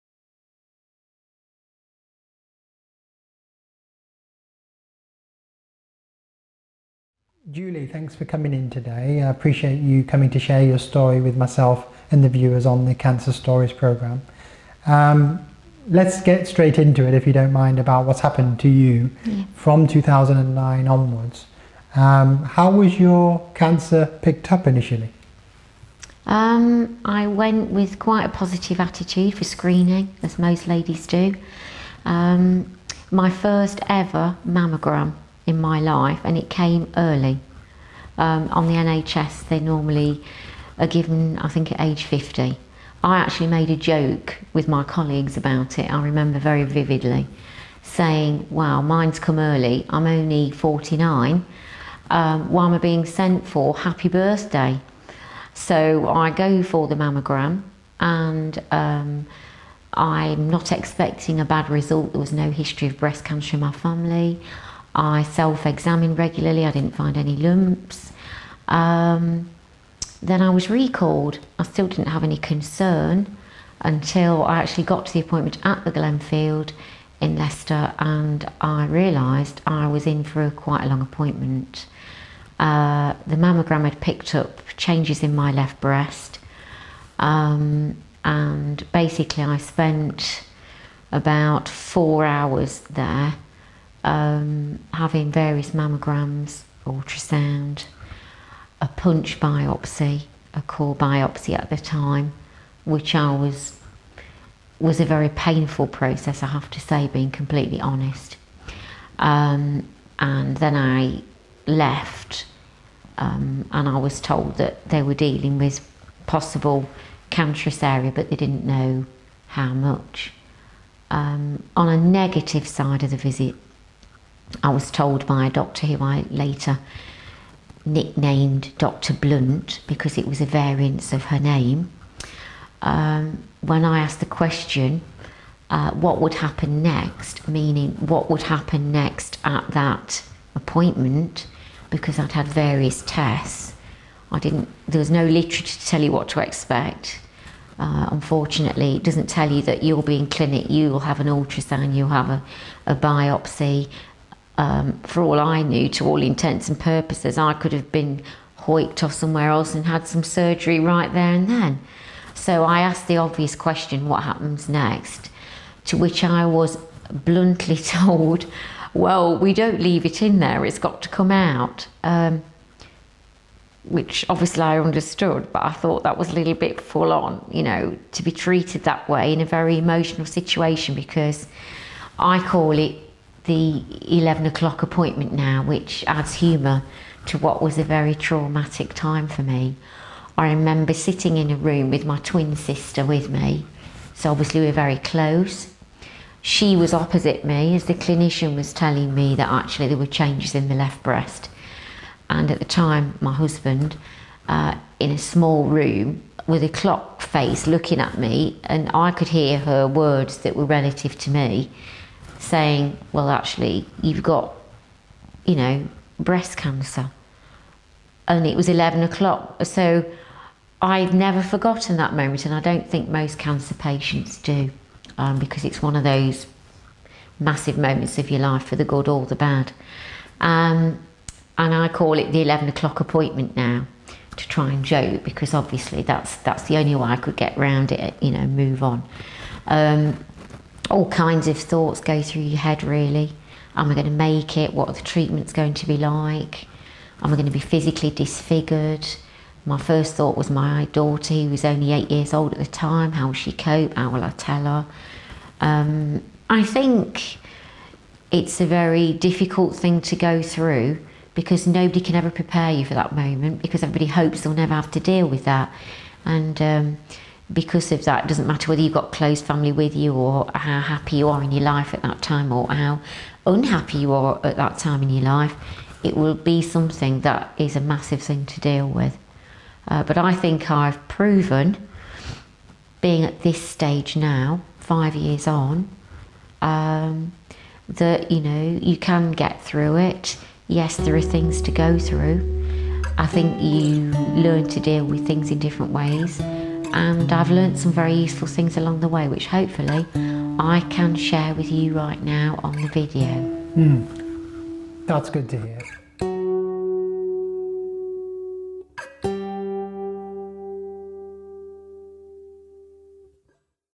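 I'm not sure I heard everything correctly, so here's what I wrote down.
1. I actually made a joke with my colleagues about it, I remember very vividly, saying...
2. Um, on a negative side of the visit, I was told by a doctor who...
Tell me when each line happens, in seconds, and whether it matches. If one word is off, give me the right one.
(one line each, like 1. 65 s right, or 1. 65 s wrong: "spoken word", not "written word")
1. 43 s right
2. 121 s right.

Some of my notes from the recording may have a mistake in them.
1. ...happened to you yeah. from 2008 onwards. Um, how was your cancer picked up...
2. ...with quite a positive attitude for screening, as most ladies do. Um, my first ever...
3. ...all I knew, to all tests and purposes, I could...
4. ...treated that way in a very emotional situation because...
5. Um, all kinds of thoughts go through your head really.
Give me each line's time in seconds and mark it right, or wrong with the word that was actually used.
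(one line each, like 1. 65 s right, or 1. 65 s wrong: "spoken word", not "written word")
1. 18 s wrong: "2009", not "2008"
2. 27 s right
3. 155 s wrong: "intents", not "tests"
4. 178 s right
5. 239 s right.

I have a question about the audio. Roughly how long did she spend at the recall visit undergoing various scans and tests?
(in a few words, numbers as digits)
4 hours.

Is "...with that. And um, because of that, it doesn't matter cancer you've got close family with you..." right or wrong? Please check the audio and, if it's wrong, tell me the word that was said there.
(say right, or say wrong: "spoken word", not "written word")
wrong: "whether", not "cancer".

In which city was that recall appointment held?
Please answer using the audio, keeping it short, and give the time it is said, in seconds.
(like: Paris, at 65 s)
Leicester, at 77 s.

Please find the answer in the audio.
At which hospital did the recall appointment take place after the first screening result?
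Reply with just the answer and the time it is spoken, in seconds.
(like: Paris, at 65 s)
Glenfield, at 75 s.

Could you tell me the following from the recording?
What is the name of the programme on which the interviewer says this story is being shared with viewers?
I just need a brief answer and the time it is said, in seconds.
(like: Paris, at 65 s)
Cancer Stories, at 12 s.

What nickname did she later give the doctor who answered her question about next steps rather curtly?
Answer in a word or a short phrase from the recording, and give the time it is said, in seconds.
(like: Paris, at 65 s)
Dr. Blunt, at 129 s.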